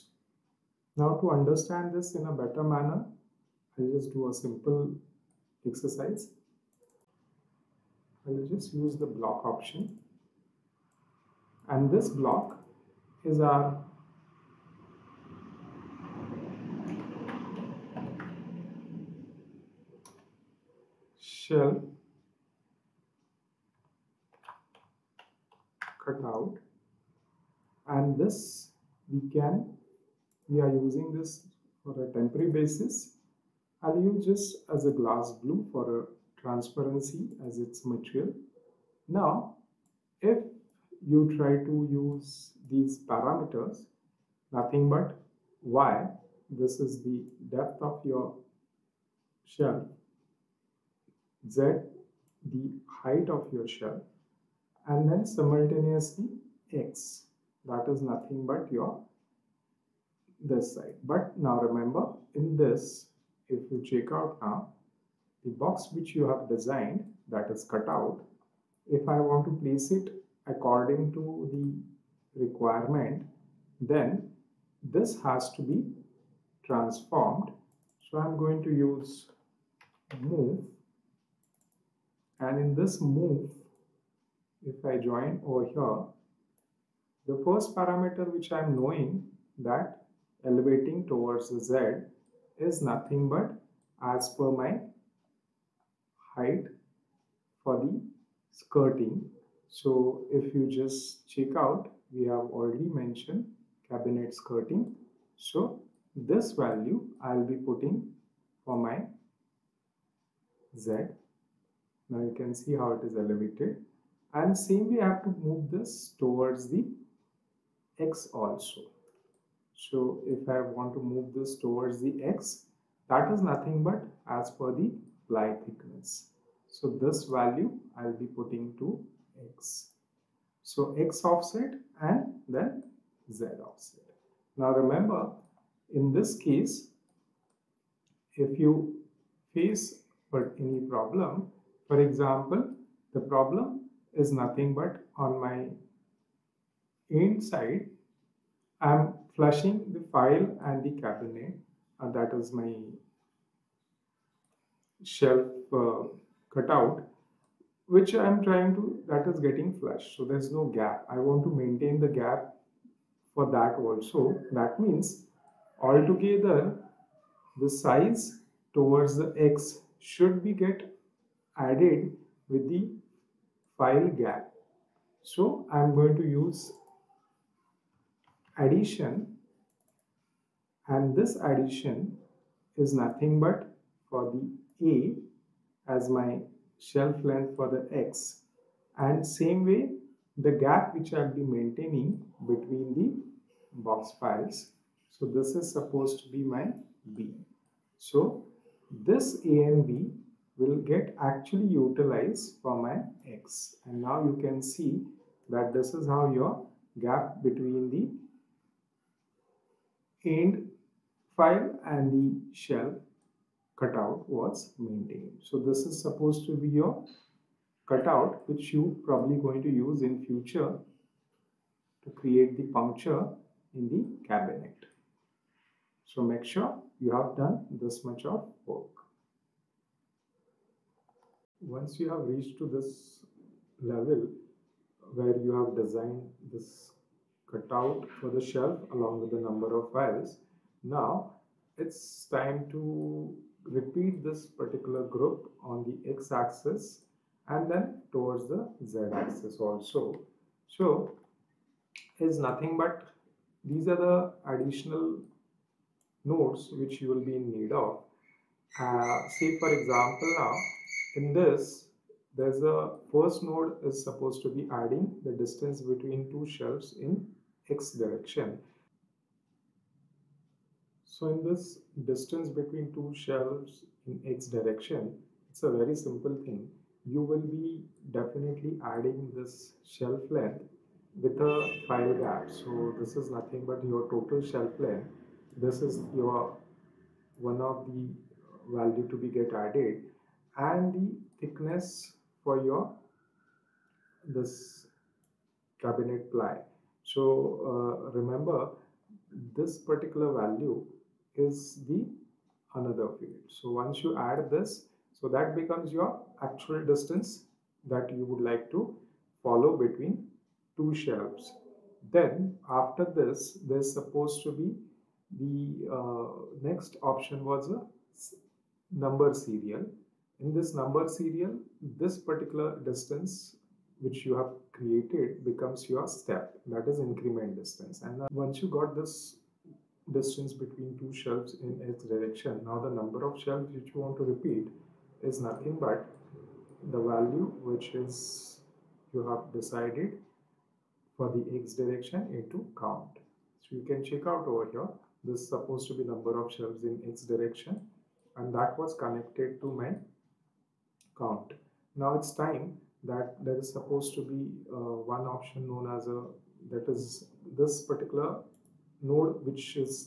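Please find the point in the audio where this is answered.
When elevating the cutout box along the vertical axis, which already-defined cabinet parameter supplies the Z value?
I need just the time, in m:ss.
1:43.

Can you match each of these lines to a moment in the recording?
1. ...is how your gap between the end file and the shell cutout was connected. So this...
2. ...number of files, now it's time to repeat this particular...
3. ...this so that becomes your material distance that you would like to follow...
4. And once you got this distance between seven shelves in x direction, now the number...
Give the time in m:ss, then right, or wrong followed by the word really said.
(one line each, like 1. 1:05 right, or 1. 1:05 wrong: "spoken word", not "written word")
1. 3:25 wrong: "maintained", not "connected"
2. 3:59 right
3. 5:04 wrong: "actual", not "material"
4. 5:28 wrong: "two", not "seven".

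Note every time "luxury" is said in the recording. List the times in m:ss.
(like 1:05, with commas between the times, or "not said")
not said.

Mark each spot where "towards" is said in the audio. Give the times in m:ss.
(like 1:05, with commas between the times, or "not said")
1:31, 1:56, 2:01, 2:48, 4:08.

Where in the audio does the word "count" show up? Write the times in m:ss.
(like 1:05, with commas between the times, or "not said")
5:42, 5:51.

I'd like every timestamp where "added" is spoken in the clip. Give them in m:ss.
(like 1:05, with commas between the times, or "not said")
2:51, 4:49.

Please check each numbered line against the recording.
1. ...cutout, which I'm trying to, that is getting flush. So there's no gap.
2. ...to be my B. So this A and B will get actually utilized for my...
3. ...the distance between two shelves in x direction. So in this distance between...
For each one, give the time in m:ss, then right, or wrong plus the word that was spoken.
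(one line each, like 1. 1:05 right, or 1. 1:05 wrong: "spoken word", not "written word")
1. 2:36 right
2. 3:16 right
3. 4:25 right.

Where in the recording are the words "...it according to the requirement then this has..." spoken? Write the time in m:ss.
1:09.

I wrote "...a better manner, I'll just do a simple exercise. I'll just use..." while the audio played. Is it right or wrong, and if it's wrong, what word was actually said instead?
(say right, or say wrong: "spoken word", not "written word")
right.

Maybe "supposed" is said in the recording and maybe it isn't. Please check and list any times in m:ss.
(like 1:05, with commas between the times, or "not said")
3:15, 3:36, 4:24, 5:13, 5:45, 5:53.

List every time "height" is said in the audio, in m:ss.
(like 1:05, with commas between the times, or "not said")
0:53, 1:36.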